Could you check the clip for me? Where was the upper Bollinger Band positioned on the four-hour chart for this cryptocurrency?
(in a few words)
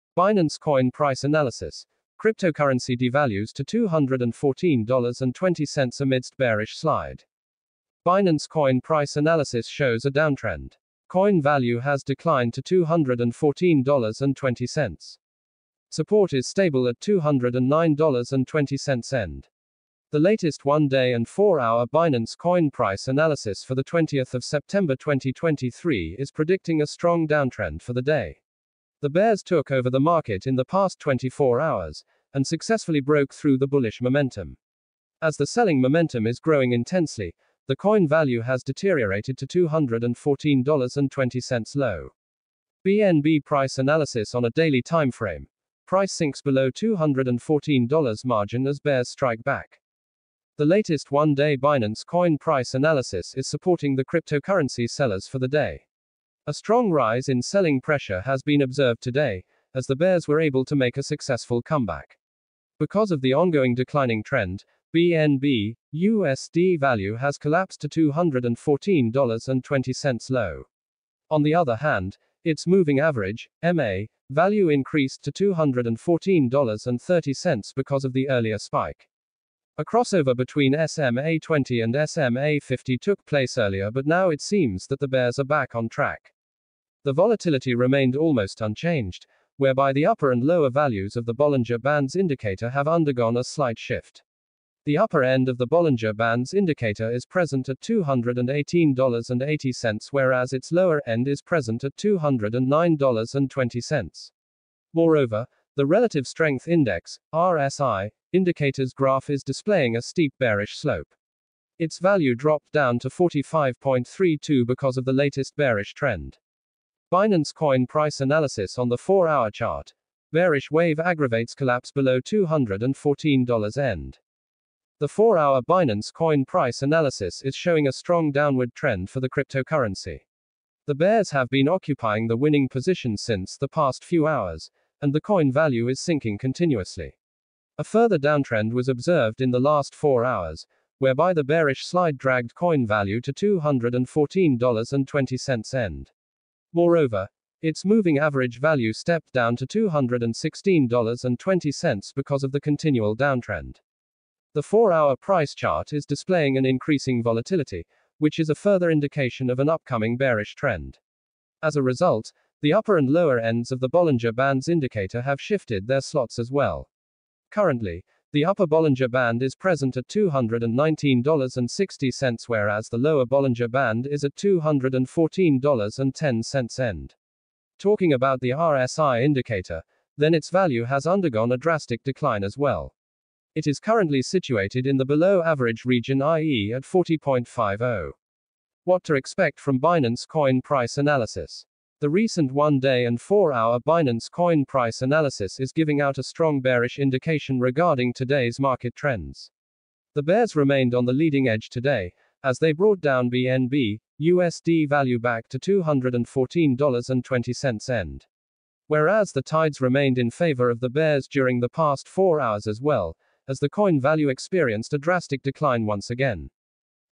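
$219.60.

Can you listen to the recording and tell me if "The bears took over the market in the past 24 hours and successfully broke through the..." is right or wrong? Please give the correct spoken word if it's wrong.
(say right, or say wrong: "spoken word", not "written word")
right.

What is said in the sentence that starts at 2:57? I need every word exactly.
Talking about the RSI indicator, then its value has undergone a drastic decline as well.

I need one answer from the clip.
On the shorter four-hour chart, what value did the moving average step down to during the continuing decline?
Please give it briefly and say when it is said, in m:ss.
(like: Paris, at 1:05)
$216.20, at 2:29.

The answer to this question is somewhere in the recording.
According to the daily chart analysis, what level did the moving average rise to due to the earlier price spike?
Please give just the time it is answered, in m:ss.
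1:15.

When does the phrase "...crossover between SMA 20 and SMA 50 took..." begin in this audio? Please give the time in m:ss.
1:19.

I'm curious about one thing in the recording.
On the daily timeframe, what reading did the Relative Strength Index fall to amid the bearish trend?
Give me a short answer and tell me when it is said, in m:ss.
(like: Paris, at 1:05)
45.32, at 1:53.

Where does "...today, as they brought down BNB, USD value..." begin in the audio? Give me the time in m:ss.
3:21.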